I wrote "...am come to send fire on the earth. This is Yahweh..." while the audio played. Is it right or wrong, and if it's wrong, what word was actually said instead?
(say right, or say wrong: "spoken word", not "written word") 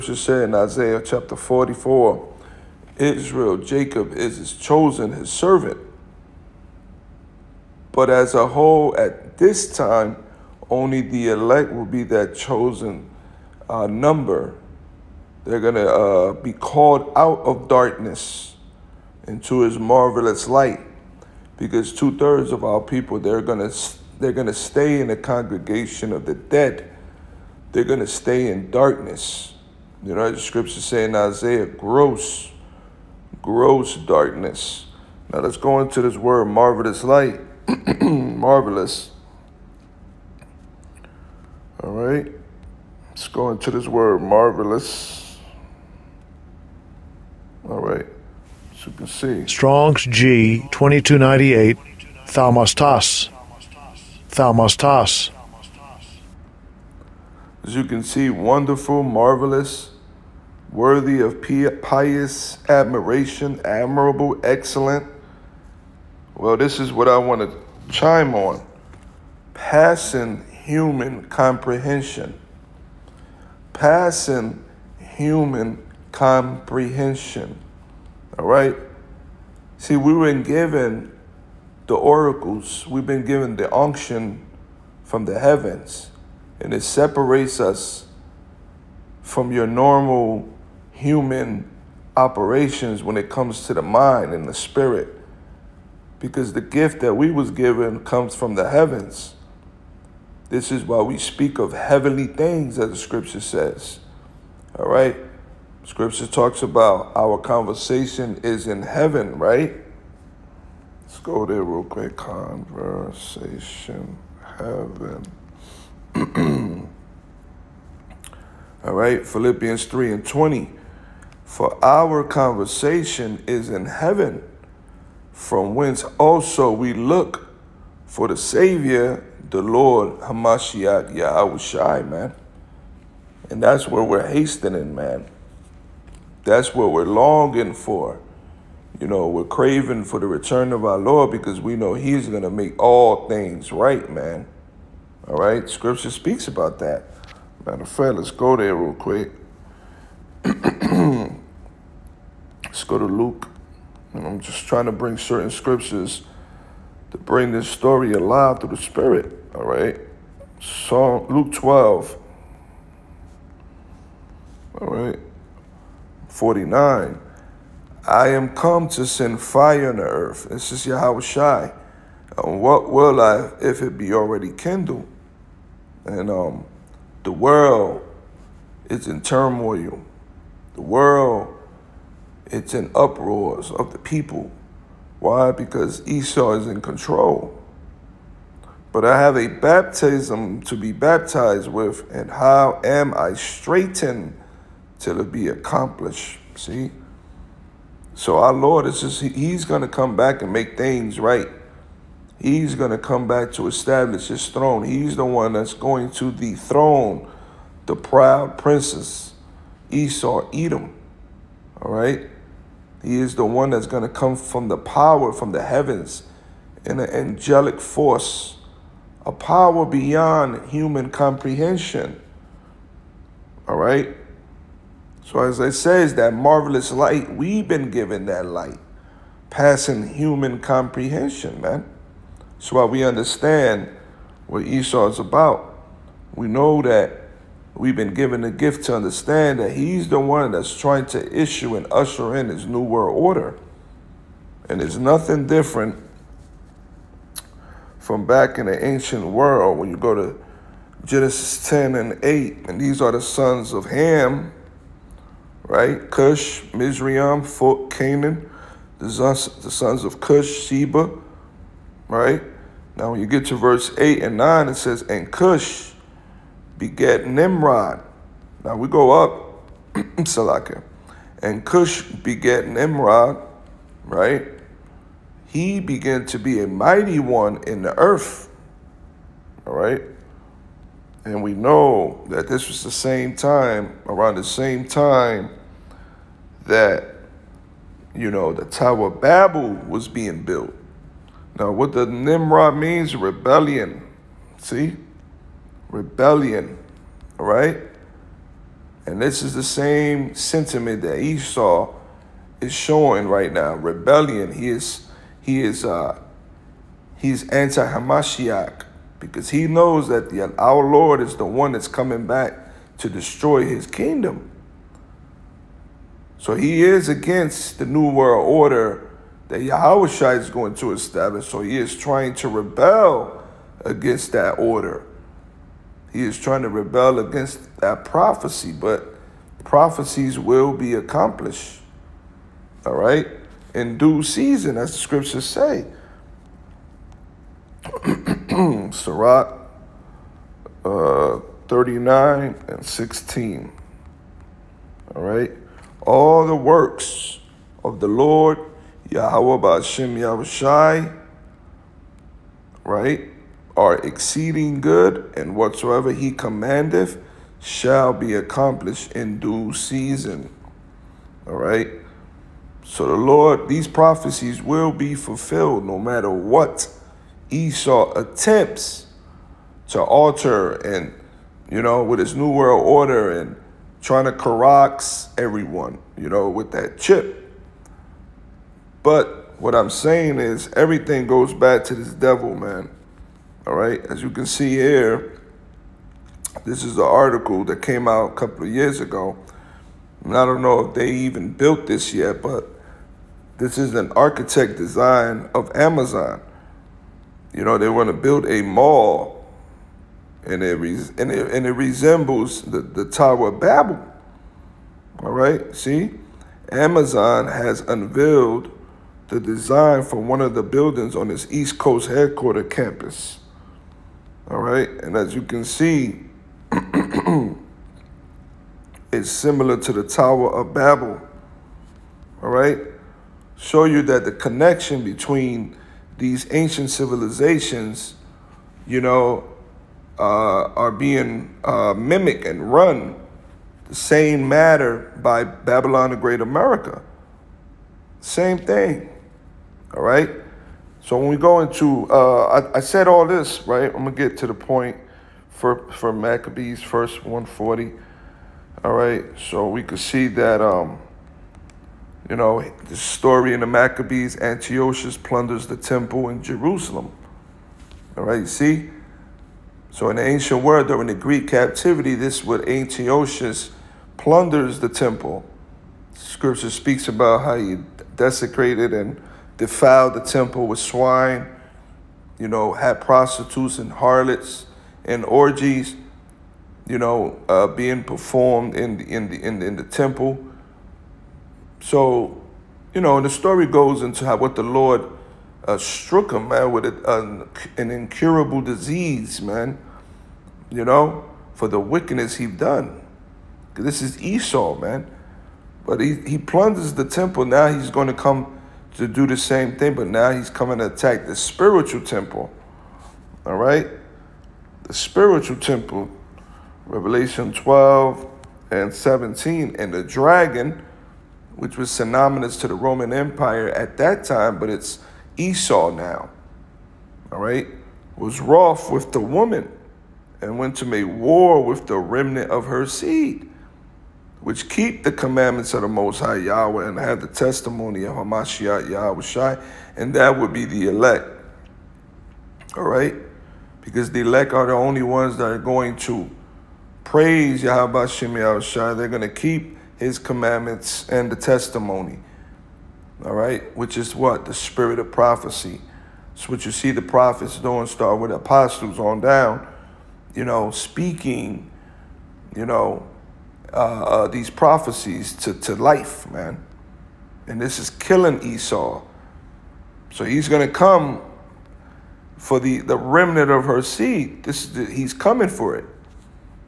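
right.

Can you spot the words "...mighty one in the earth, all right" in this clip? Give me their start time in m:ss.
4:36.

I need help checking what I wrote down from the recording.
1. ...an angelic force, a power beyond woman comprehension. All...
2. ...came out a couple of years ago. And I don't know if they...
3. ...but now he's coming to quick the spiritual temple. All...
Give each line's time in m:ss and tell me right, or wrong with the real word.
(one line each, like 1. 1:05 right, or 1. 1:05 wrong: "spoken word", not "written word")
1. 3:36 wrong: "human", not "woman"
2. 6:27 right
3. 8:19 wrong: "attack", not "quick".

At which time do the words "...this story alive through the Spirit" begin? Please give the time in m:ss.
2:37.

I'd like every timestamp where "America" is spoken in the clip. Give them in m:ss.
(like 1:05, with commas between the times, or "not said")
7:16.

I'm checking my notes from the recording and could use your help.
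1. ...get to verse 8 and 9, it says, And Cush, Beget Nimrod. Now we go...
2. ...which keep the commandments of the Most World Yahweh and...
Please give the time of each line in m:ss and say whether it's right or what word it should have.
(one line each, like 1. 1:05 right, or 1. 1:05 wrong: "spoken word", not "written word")
1. 4:23 right
2. 8:44 wrong: "High", not "World".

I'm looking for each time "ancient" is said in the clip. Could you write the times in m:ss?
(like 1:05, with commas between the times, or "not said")
4:08, 7:06, 7:40.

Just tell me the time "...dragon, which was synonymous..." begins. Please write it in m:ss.
8:30.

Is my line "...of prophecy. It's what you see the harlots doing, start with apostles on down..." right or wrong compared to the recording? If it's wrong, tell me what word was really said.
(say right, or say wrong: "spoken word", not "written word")
wrong: "prophets", not "harlots".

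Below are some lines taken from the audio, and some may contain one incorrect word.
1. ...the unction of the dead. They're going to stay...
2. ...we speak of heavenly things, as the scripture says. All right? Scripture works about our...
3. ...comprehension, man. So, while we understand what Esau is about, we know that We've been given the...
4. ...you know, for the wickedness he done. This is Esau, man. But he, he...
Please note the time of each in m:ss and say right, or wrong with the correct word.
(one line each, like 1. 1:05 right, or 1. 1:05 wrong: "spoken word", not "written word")
1. 0:25 wrong: "congregation", not "unction"
2. 1:41 wrong: "talks", not "works"
3. 3:50 right
4. 8:10 right.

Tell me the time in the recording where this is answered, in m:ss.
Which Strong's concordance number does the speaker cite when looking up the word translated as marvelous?
0:50.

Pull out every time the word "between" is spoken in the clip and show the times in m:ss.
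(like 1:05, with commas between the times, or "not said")
7:05.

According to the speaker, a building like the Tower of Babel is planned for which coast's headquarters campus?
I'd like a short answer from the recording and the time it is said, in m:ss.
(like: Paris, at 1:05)
East Coast, at 6:51.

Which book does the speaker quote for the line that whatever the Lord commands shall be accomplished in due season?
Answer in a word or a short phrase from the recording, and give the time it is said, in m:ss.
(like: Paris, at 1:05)
Sirach, at 5:38.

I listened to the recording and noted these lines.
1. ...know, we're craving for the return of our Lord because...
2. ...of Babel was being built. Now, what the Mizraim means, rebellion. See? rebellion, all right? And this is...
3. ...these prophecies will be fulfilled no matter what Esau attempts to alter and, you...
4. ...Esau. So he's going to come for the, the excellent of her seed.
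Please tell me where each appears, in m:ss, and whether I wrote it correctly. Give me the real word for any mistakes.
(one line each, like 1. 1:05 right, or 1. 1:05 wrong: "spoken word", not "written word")
1. 2:19 right
2. 4:49 wrong: "Nimrod", not "Mizraim"
3. 6:03 right
4. 9:18 wrong: "remnant", not "excellent".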